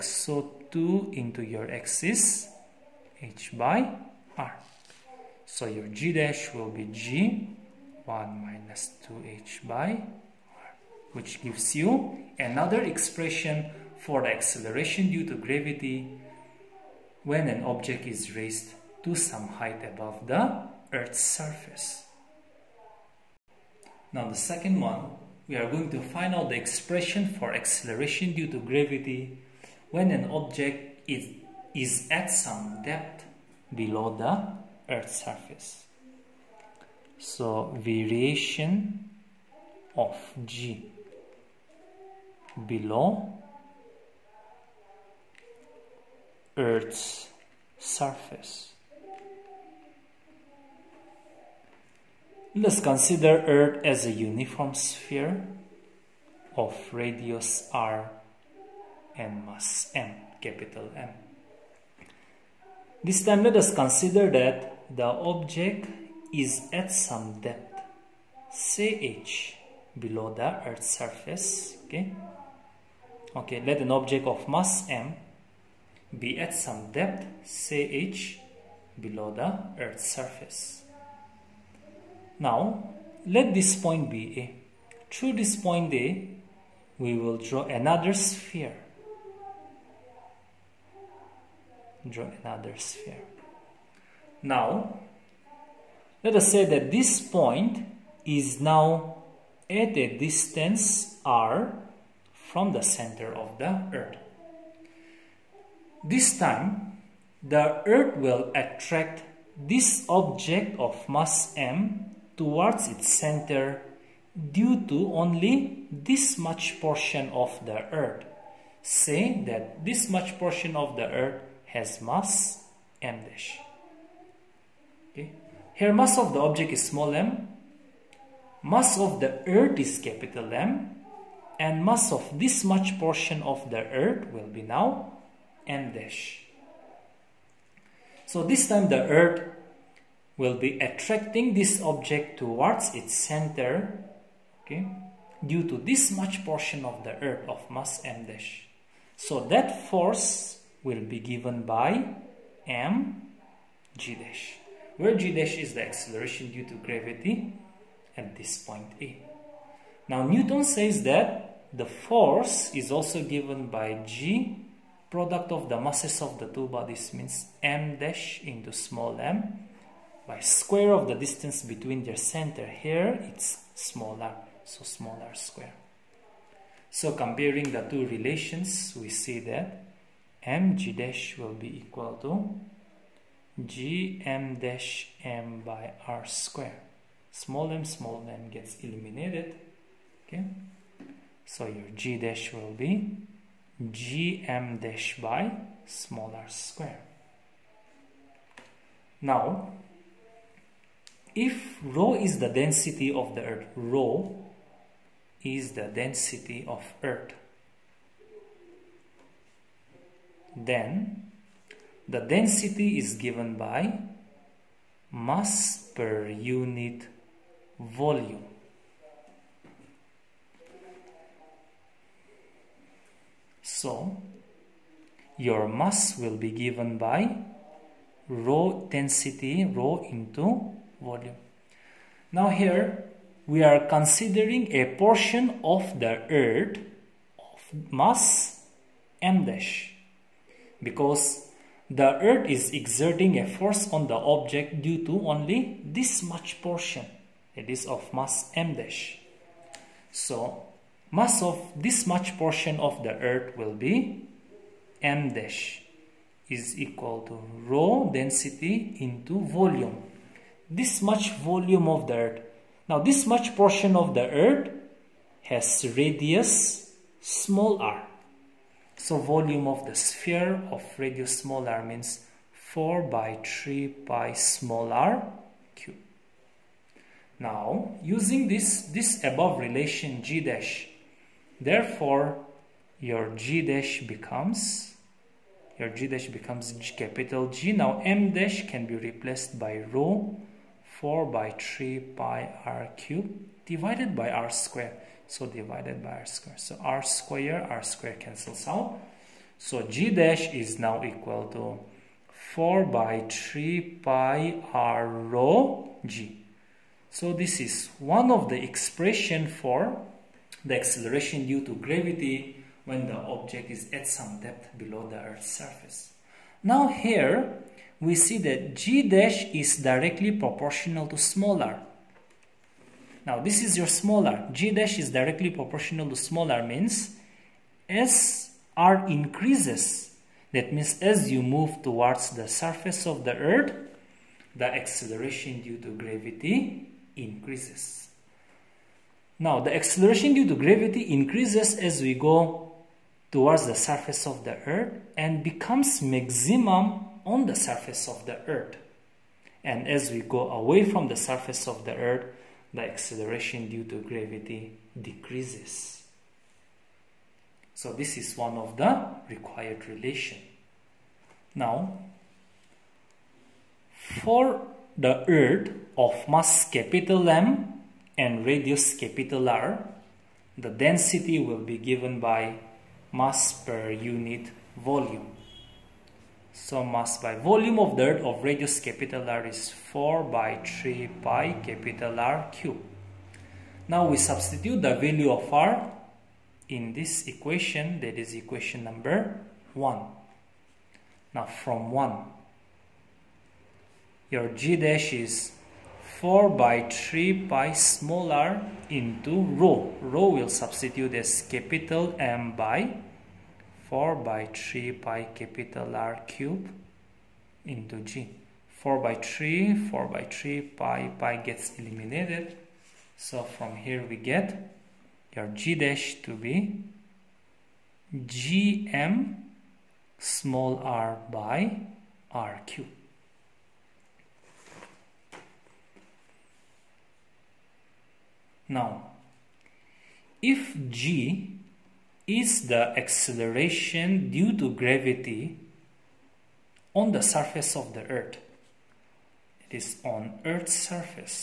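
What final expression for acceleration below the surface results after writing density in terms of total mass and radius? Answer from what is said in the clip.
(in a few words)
GMr/R^3.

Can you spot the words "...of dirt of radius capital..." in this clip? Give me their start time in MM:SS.
06:17.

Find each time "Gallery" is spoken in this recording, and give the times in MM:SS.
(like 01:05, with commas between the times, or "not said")
not said.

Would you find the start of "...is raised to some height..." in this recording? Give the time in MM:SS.
00:18.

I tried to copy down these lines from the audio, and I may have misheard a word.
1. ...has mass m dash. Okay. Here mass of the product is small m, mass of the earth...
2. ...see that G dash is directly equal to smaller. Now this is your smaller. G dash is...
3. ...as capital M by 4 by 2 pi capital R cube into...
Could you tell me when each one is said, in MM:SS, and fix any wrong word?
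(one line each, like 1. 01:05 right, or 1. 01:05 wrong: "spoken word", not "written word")
1. 02:01 wrong: "object", not "product"
2. 05:18 wrong: "proportional", not "equal"
3. 06:41 wrong: "3", not "2".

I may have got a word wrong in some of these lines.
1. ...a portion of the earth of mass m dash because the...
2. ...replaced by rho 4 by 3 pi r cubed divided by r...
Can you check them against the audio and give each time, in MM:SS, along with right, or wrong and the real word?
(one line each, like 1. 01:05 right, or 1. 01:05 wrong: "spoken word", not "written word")
1. 03:54 right
2. 04:48 right.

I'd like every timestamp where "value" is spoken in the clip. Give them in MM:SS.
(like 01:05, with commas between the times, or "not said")
06:24.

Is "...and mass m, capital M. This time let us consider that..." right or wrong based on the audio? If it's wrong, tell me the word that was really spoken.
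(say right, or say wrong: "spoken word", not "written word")
right.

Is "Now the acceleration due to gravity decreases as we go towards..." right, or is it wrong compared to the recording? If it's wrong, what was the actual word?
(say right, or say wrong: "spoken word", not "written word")
wrong: "increases", not "decreases".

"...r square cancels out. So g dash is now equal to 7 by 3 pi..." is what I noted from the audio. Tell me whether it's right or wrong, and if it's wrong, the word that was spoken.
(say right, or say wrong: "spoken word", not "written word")
wrong: "4", not "7".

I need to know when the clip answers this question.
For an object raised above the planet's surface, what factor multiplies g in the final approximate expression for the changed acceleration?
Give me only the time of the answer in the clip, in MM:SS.
00:08.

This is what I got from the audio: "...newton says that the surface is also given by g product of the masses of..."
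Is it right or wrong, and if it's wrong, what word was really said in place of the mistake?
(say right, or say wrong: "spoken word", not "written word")
wrong: "force", not "surface".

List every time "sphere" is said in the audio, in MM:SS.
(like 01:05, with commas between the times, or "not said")
00:54, 01:28, 01:32, 04:29.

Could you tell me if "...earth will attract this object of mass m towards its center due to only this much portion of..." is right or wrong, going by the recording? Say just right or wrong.
right.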